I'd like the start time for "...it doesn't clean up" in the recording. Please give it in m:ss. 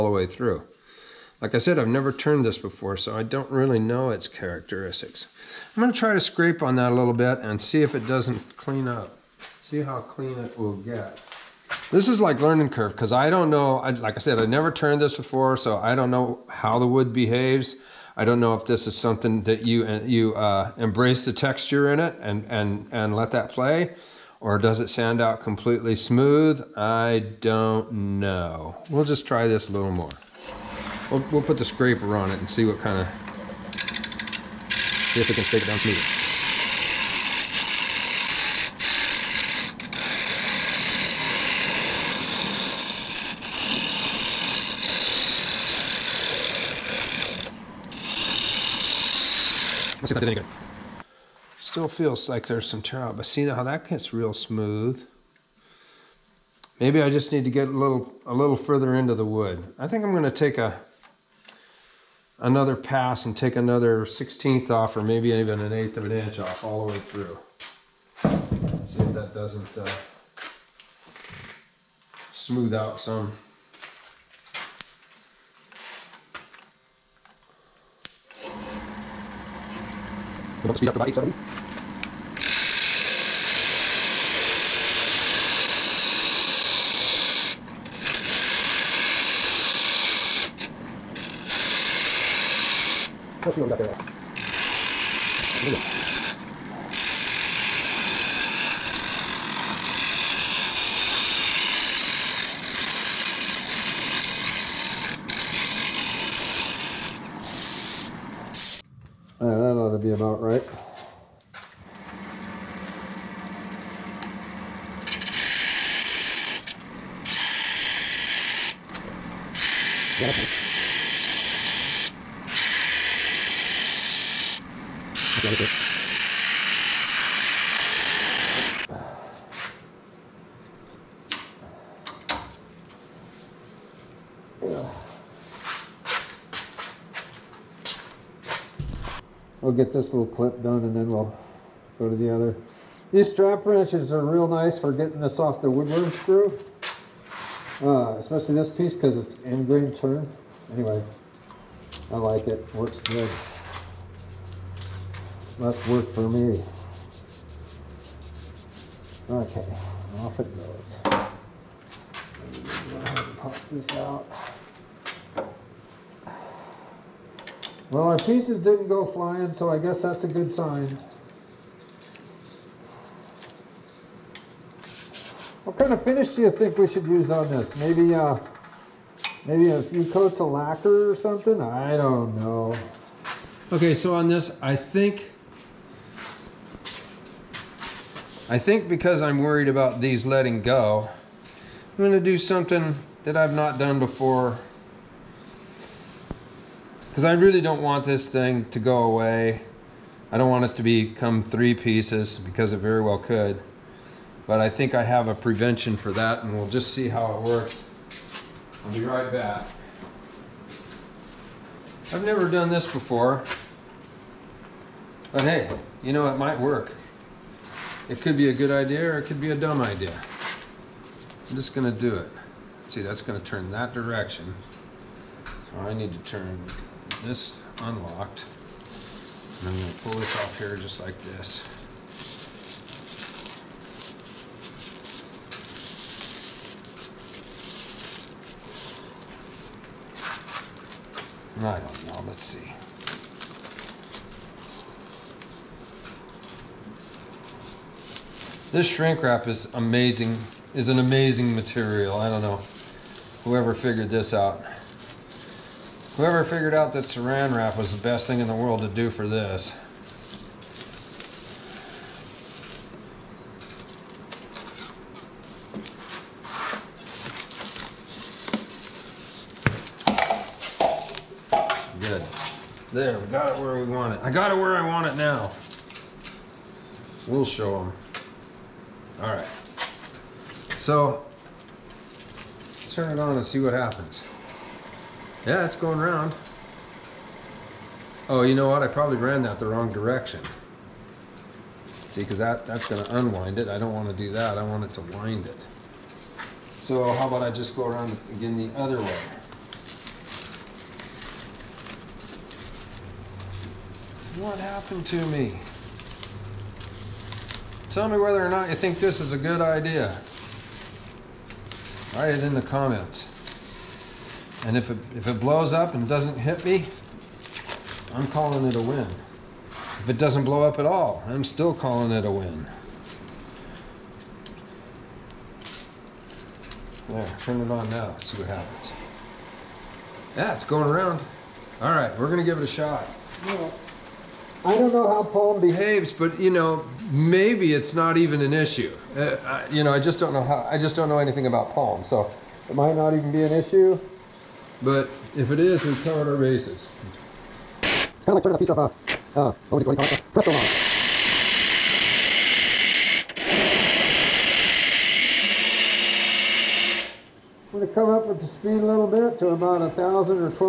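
0:07.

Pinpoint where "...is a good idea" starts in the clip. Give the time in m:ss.
5:09.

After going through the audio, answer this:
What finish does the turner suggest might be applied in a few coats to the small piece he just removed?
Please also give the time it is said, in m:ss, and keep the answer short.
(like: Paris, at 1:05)
Lacquer, at 3:00.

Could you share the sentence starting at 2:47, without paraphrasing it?
Well, our pieces didn't go flying, so I guess that's a good sign.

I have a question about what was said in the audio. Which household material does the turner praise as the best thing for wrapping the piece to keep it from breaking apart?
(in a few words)
Saran wrap.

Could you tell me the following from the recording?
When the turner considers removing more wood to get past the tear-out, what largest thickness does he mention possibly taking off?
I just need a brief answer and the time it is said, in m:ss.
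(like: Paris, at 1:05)
1/8 inch, at 1:05.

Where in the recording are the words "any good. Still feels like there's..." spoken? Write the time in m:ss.
0:50.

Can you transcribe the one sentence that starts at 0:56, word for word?
Maybe I just need to get a little a little further into the wood.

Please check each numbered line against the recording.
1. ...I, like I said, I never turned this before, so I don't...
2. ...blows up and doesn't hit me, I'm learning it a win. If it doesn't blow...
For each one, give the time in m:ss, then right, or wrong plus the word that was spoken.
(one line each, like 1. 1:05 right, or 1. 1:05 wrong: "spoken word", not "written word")
1. 0:13 right
2. 5:15 wrong: "calling", not "learning".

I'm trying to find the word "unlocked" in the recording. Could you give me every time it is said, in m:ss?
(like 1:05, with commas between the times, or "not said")
3:47.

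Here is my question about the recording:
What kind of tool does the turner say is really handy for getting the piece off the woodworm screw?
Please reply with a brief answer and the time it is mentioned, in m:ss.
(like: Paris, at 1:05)
Strap wrenches, at 2:23.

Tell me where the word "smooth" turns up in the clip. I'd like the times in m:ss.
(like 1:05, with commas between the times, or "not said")
0:25, 0:35, 0:54, 1:12.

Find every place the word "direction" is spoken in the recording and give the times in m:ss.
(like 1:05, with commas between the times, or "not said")
3:43, 4:49.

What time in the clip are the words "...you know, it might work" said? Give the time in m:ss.
3:36.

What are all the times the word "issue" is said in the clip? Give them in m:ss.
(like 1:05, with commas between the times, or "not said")
5:38, 5:43.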